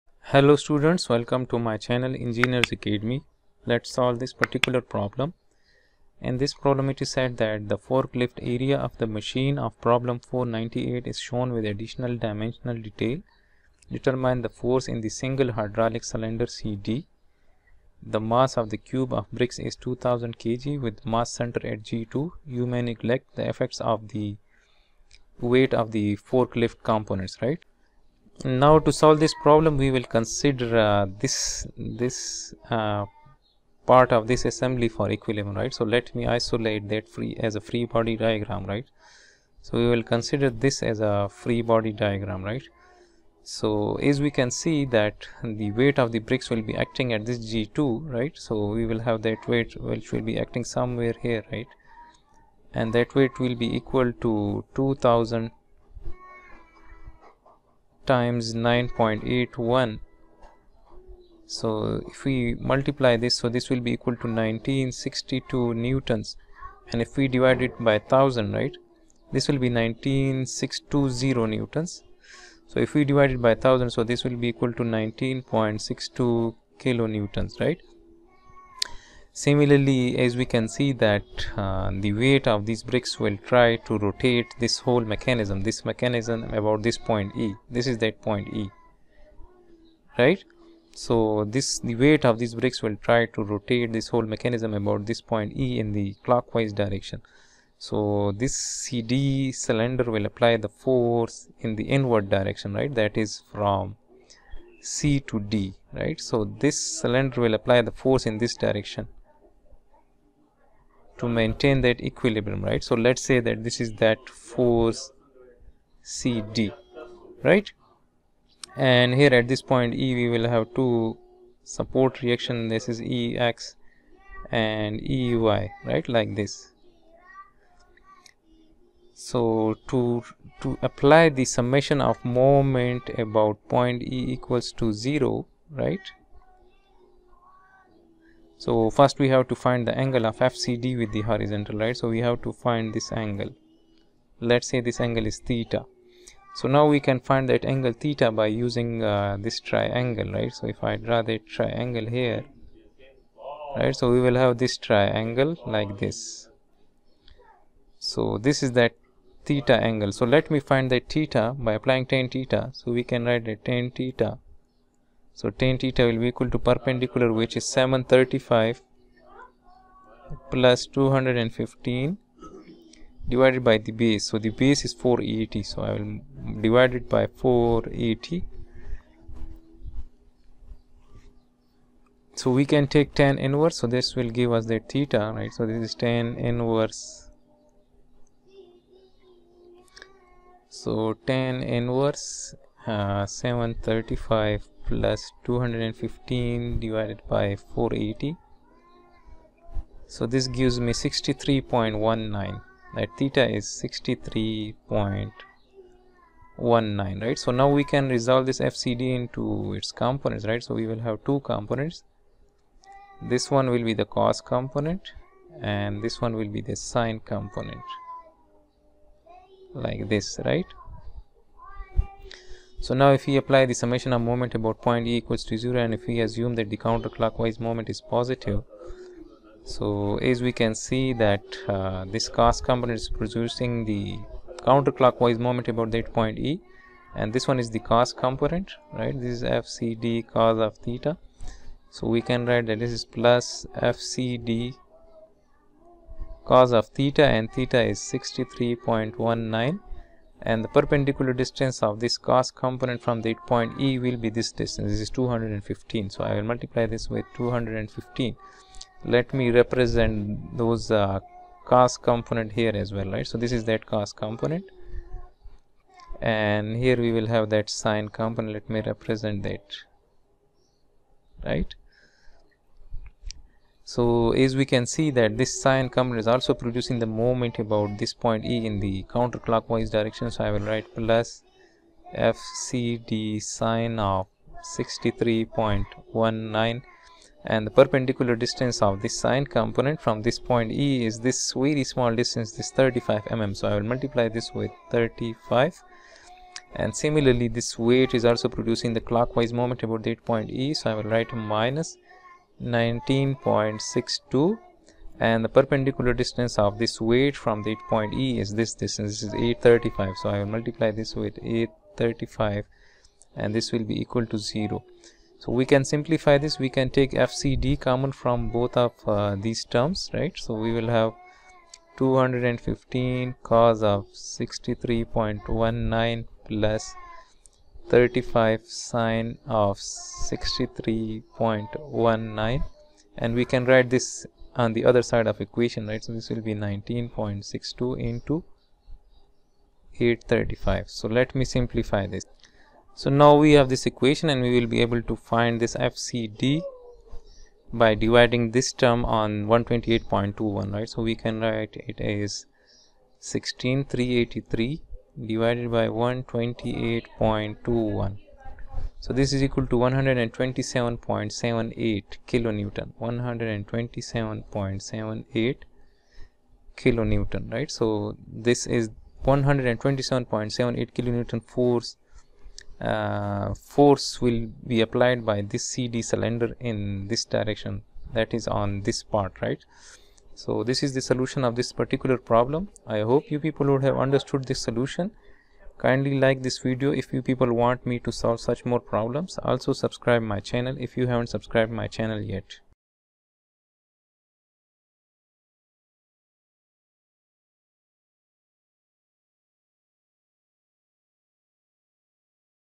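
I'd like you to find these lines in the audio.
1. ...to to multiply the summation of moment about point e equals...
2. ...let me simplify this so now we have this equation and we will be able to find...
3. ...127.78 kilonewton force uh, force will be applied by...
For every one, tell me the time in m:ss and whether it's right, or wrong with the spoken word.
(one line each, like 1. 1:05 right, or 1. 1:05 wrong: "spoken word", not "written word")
1. 2:09 wrong: "apply", not "multiply"
2. 5:41 right
3. 6:09 right.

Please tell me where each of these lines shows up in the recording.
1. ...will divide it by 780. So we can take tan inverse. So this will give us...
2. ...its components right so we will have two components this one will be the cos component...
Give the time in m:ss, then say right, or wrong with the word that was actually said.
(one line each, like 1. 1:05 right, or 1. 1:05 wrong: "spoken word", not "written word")
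1. 2:55 wrong: "480", not "780"
2. 3:29 right.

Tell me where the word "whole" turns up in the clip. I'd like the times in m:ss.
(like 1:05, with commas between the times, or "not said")
1:24, 1:34.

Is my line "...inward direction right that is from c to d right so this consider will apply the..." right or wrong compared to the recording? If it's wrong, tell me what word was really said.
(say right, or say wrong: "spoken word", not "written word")
wrong: "cylinder", not "consider".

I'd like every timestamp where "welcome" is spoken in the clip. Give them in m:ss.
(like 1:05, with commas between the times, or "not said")
0:01.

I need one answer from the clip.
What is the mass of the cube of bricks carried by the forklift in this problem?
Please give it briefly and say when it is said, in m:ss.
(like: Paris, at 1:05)
2000 kg, at 0:19.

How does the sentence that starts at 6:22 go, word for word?
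I hope you people would have understood this solution.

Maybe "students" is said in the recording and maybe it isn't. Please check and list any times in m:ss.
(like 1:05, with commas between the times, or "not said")
0:00.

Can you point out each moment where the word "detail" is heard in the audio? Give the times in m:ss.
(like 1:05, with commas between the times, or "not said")
0:12.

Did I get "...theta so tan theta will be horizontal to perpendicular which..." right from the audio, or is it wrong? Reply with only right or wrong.
wrong.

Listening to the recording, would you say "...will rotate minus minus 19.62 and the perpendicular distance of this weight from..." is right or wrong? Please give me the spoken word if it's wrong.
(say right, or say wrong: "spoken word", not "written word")
wrong: "write", not "rotate".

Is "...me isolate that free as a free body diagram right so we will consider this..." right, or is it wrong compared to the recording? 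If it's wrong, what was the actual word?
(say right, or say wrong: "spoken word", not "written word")
right.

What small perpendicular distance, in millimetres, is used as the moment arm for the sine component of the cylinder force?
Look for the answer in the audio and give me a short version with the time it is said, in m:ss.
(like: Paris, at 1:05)
35 mm, at 4:52.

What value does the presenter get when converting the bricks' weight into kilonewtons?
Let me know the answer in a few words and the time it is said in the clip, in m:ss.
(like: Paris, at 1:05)
19.62 kN, at 1:14.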